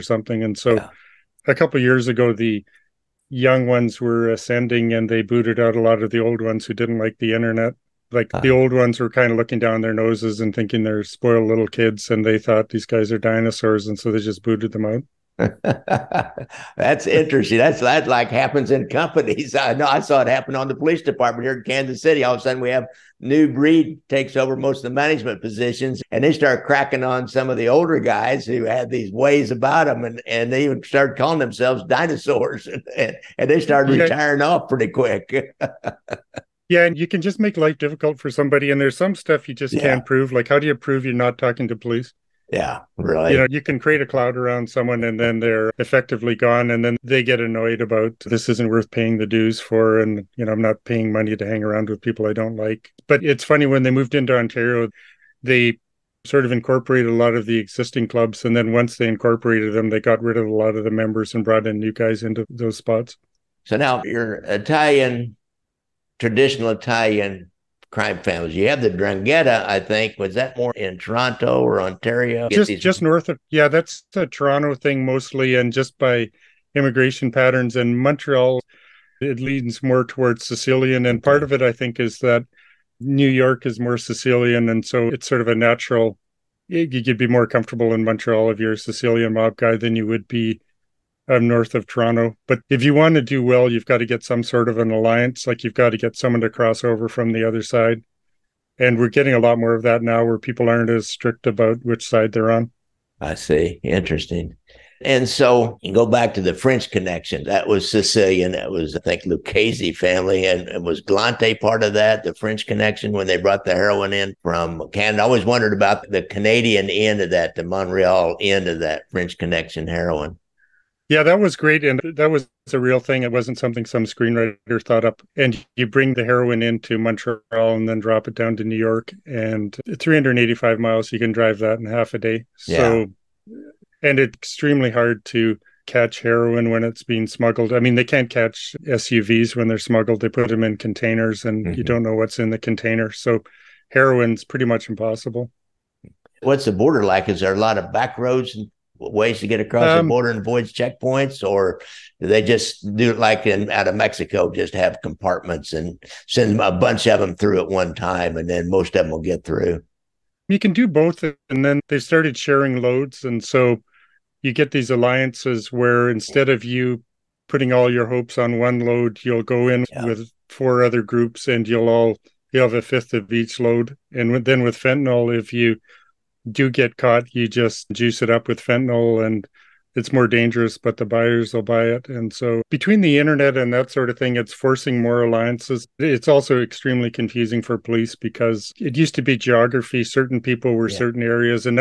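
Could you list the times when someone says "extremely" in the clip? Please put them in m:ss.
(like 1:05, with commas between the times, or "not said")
2:14, 3:06.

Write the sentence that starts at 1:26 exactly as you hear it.
You'd be more comfortable in Montreal if you're a Sicilian mob guy than you would be north of Toronto.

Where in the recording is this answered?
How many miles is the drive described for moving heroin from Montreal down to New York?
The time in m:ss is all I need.
2:09.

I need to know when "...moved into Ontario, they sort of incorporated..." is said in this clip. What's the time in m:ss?
0:53.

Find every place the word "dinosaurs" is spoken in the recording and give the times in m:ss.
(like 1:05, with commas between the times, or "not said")
0:13, 0:31.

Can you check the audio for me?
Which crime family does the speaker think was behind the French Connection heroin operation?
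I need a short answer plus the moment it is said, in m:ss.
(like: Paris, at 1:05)
Lucchese family, at 1:49.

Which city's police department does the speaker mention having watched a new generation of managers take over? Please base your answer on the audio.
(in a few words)
Kansas City.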